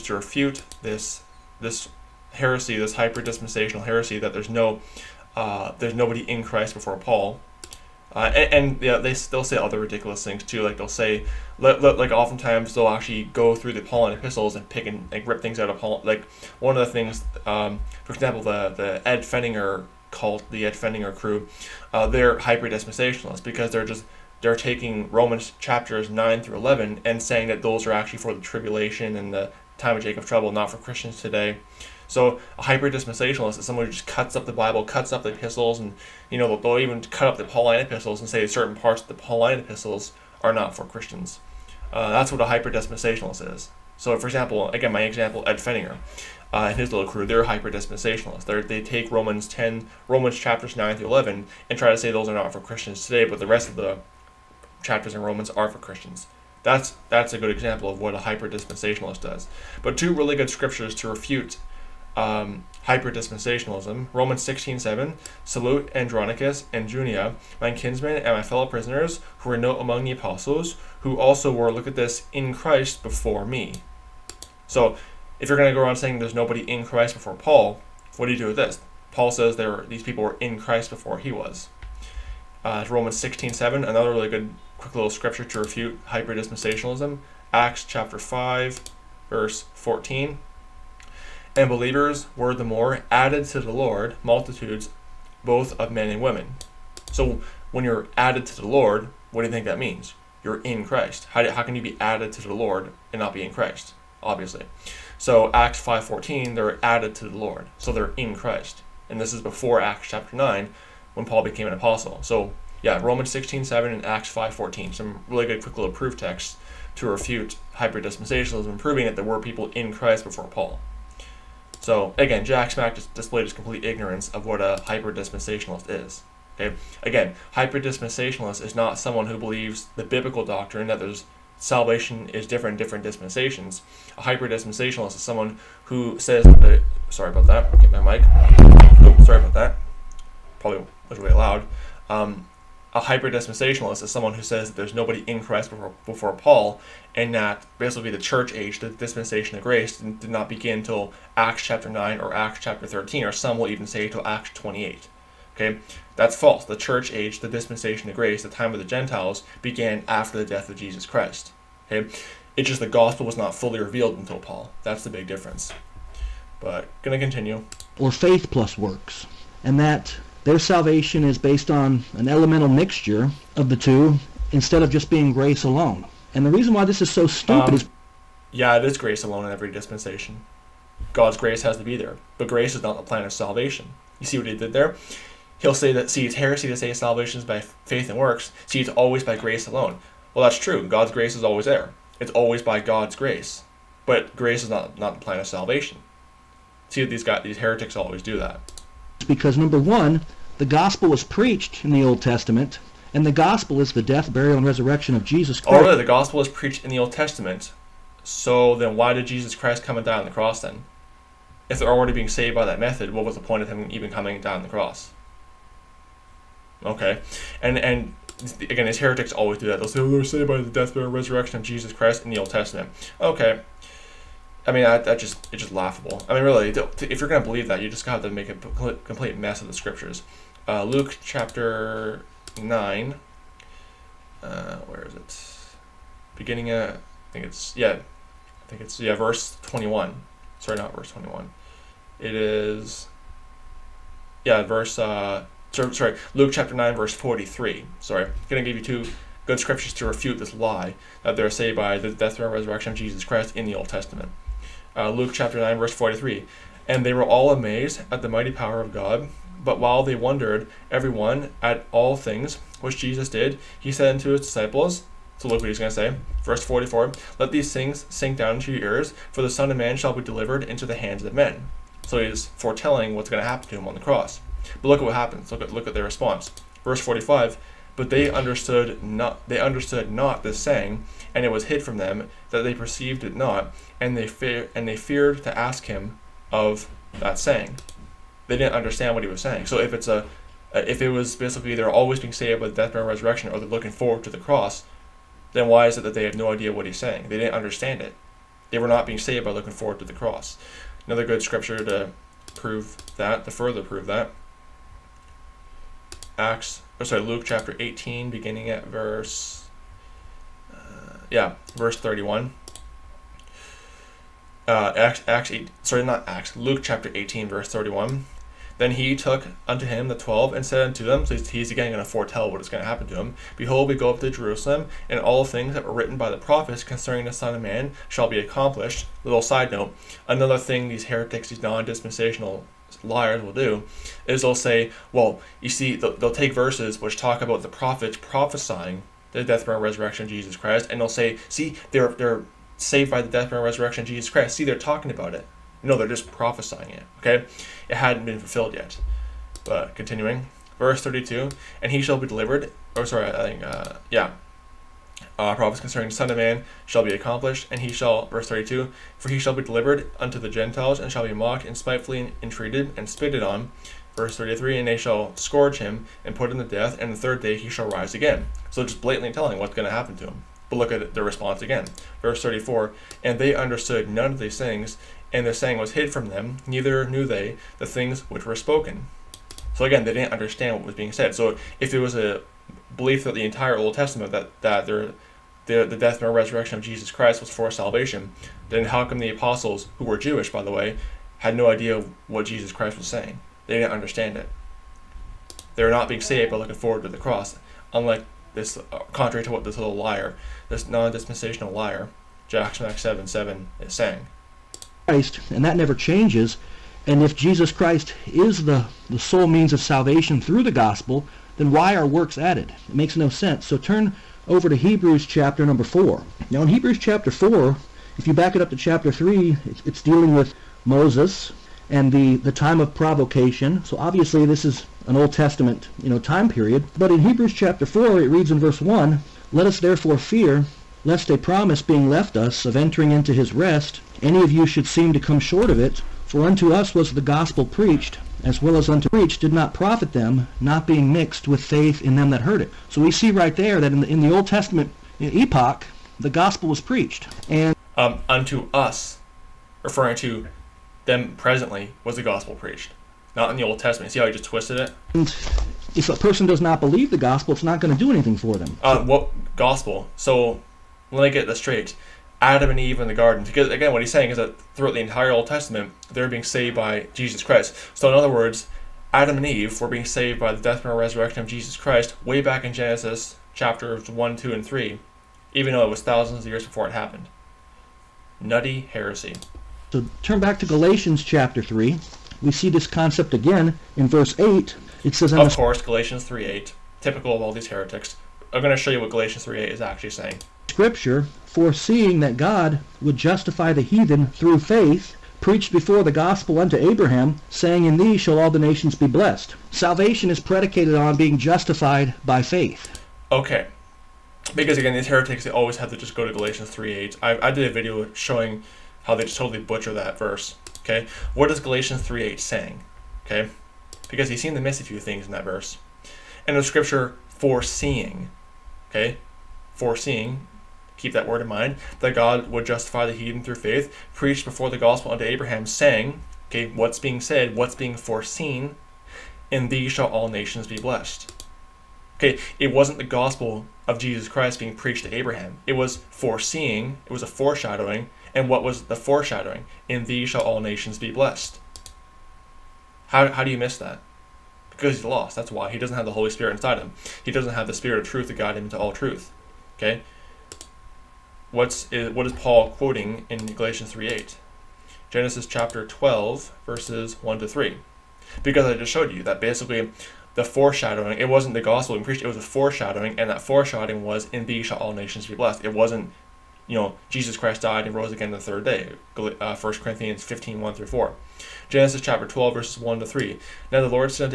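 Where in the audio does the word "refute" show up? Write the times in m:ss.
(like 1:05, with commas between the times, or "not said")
0:00, 1:01, 1:25, 1:57, 4:10.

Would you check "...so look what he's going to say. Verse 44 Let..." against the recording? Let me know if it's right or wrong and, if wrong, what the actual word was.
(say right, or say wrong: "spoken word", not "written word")
right.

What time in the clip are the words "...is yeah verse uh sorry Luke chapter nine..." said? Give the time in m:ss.
4:02.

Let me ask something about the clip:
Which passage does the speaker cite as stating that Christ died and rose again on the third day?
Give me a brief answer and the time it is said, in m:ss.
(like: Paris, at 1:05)
1 Corinthians 15:1-4, at 9:29.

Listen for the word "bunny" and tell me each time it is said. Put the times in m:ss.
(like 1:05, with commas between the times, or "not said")
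not said.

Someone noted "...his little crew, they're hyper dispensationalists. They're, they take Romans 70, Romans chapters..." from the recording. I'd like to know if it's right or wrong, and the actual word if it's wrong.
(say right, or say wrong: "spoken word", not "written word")
wrong: "10", not "70".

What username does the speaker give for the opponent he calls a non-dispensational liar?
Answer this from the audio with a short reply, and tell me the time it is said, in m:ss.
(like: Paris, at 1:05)
Jack Smack 77, at 6:42.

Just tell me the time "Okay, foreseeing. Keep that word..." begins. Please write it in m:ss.
8:38.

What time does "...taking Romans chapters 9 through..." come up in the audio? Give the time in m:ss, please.
0:24.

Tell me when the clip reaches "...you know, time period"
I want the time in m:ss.
7:06.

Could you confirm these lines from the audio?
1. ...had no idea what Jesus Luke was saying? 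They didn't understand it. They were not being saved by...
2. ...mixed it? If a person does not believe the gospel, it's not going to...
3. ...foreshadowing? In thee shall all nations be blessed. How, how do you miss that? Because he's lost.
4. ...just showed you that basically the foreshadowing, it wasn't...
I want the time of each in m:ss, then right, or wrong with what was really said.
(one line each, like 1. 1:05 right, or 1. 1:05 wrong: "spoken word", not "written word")
1. 6:31 wrong: "Christ", not "Luke"
2. 7:34 wrong: "twisted", not "mixed"
3. 8:58 right
4. 9:18 right.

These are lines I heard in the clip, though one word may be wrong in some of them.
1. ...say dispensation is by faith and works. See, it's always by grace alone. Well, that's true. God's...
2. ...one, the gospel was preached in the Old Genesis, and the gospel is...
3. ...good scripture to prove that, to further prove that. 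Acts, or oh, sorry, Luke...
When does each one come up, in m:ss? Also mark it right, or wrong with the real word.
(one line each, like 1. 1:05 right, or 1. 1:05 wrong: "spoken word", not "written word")
1. 3:06 wrong: "salvation", not "dispensation"
2. 3:19 wrong: "Testament", not "Genesis"
3. 5:01 right.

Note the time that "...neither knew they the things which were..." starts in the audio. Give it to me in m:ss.
6:16.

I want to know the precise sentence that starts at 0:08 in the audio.
Uh, and, and yeah, they they'll say other ridiculous things too.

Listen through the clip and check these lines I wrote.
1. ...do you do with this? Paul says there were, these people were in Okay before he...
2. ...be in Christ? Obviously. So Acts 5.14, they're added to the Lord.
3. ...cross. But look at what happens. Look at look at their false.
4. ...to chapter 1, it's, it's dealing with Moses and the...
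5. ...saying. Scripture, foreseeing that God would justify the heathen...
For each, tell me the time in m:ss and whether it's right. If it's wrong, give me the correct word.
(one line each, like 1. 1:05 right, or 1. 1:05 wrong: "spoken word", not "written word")
1. 1:18 wrong: "Christ", not "Okay"
2. 1:43 right
3. 4:33 wrong: "response", not "false"
4. 6:58 wrong: "3", not "1"
5. 8:10 right.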